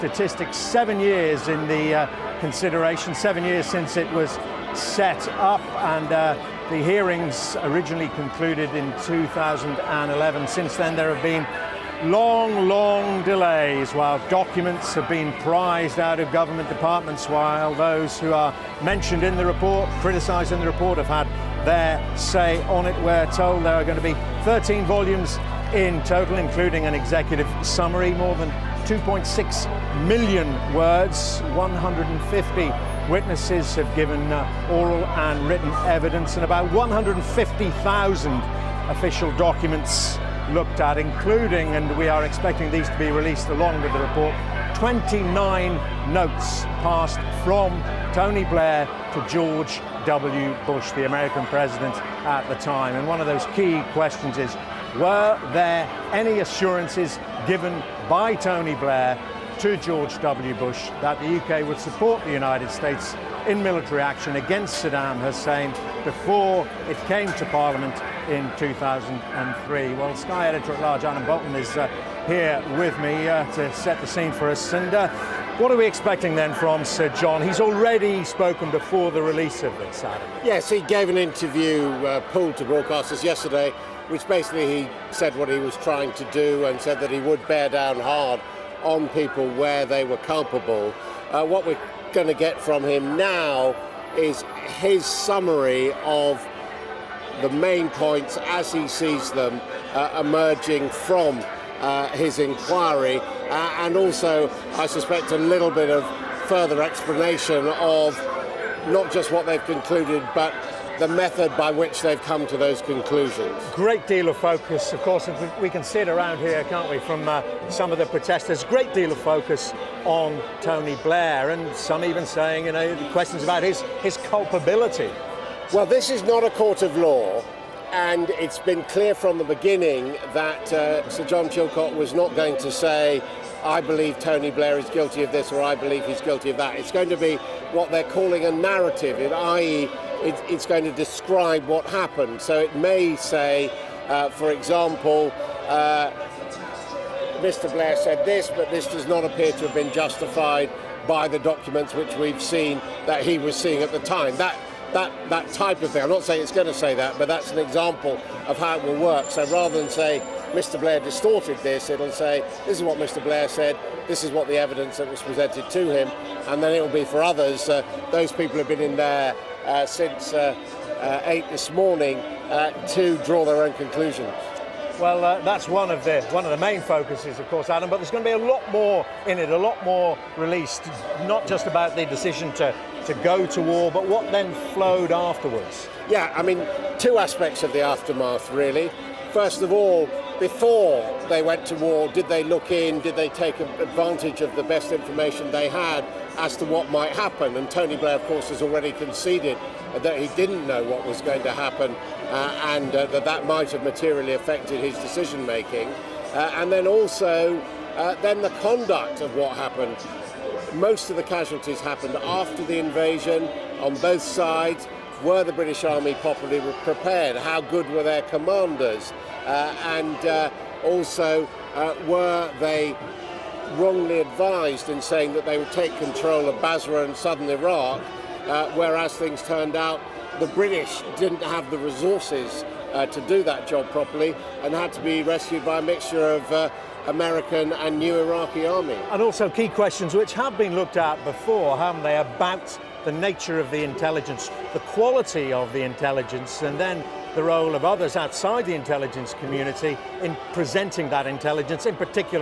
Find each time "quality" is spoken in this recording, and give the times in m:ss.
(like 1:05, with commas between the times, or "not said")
4:04.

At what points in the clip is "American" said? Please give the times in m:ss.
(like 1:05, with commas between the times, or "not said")
0:51, 3:57.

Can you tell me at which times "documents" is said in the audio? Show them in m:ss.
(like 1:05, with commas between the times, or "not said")
0:14, 0:39, 2:31.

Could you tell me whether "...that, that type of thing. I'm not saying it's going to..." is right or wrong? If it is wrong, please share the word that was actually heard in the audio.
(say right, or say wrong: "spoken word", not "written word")
right.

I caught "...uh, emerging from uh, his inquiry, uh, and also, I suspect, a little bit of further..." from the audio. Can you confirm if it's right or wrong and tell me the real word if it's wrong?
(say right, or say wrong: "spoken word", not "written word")
right.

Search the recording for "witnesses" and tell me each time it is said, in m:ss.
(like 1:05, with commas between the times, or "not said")
0:33.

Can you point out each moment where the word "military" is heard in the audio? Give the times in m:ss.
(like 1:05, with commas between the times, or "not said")
1:03.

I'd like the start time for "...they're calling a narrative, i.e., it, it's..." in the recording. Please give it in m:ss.
2:17.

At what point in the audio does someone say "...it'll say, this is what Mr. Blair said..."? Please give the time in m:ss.
2:41.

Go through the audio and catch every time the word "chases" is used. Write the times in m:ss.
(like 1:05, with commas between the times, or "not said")
not said.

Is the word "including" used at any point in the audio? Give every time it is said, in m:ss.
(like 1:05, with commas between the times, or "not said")
0:26, 0:40.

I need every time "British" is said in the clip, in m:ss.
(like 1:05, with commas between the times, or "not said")
3:35, 3:50.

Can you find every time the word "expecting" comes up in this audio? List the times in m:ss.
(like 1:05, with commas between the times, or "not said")
0:42, 1:15.